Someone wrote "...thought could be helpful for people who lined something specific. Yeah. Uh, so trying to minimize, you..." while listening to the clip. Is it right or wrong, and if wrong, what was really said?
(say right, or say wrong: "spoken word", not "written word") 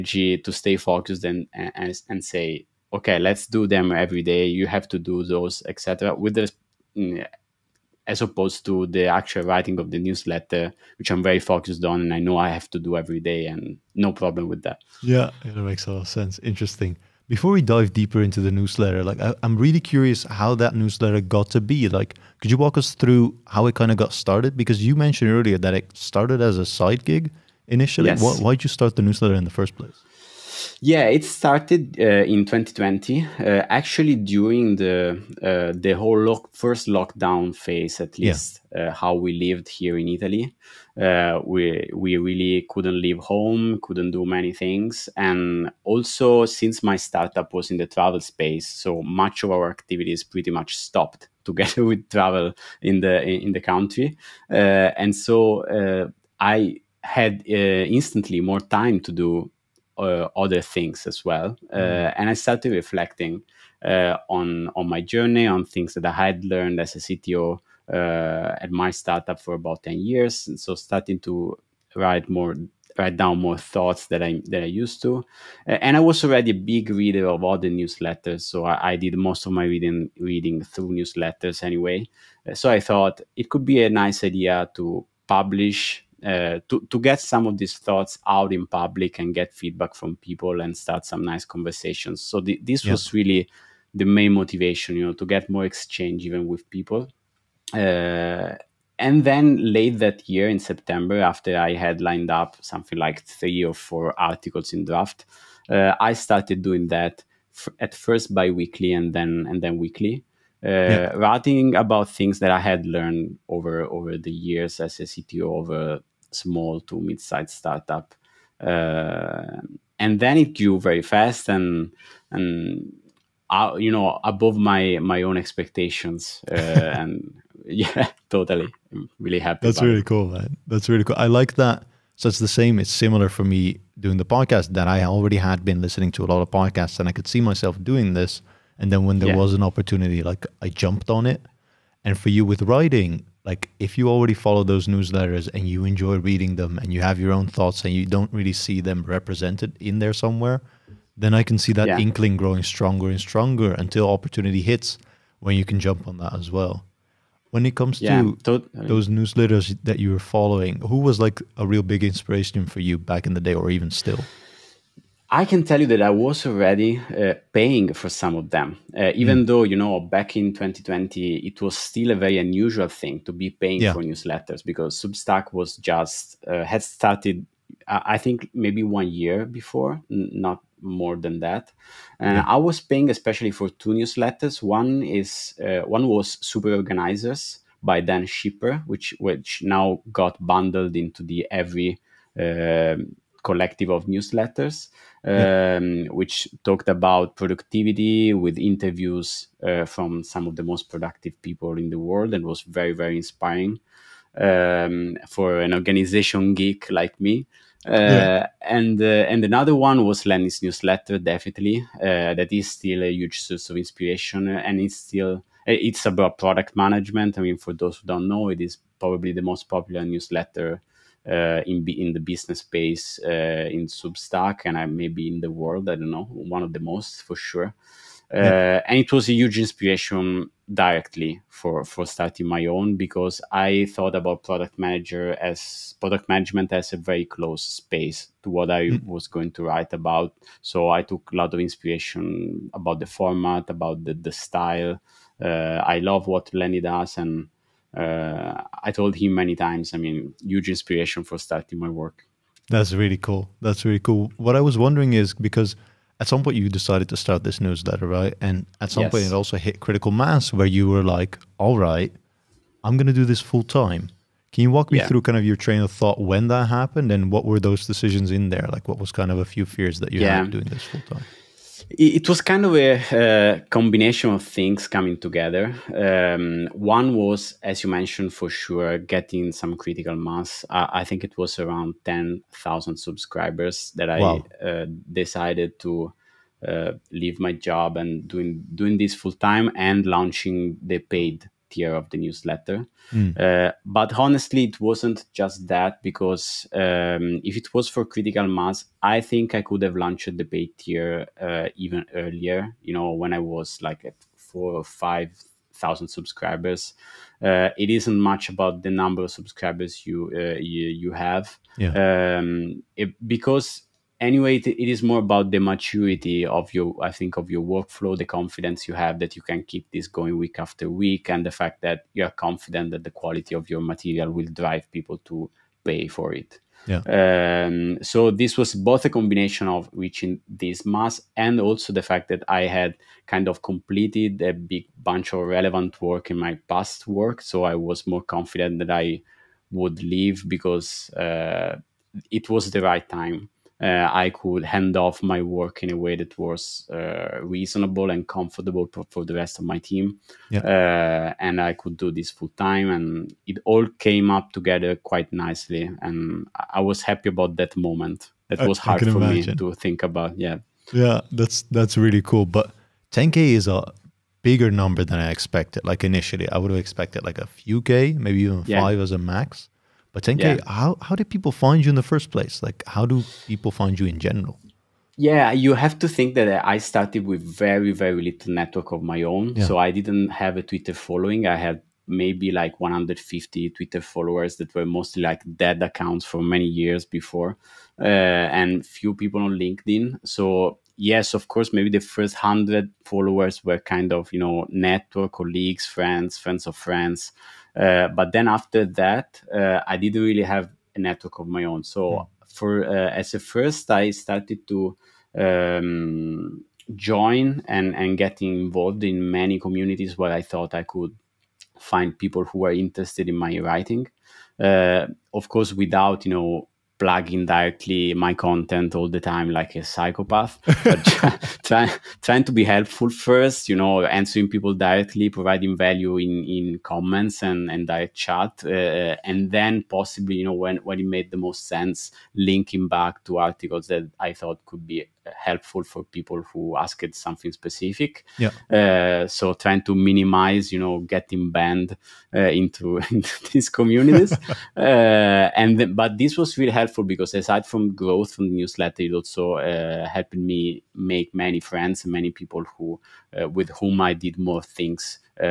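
wrong: "asked", not "lined".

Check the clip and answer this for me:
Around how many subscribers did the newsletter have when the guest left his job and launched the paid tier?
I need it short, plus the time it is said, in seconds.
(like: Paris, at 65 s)
10,000, at 282 s.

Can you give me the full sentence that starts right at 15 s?
Yeah, it makes a lot of sense.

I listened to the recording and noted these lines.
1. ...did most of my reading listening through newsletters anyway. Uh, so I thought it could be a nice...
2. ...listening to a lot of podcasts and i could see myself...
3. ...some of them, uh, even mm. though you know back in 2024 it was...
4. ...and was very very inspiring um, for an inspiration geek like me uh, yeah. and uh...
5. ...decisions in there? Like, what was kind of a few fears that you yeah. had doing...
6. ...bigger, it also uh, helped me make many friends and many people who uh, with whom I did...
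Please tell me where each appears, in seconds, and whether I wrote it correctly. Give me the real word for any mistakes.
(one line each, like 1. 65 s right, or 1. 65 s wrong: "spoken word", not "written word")
1. 78 s wrong: "reading", not "listening"
2. 135 s right
3. 168 s wrong: "2020", not "2024"
4. 202 s wrong: "organization", not "inspiration"
5. 267 s right
6. 448 s wrong: "newsletter", not "bigger".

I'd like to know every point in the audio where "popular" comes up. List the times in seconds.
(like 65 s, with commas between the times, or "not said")
219 s.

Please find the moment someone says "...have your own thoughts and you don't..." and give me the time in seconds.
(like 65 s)
147 s.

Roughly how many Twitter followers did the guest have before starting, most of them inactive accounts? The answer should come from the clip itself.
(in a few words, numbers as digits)
150.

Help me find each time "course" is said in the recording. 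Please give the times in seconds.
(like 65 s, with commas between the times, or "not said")
391 s, 415 s.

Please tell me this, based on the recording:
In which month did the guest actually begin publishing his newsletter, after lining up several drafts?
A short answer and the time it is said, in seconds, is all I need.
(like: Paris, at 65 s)
September, at 100 s.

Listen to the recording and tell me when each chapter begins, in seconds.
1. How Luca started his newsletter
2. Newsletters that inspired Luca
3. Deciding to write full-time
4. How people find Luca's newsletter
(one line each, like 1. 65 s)
1. 16 s
2. 156 s
3. 252 s
4. 362 s.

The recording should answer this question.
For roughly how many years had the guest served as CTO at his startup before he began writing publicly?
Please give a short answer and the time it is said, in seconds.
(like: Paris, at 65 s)
10, at 69 s.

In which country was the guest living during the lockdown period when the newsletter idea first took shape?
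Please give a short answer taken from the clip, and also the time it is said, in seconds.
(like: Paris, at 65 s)
Italy, at 40 s.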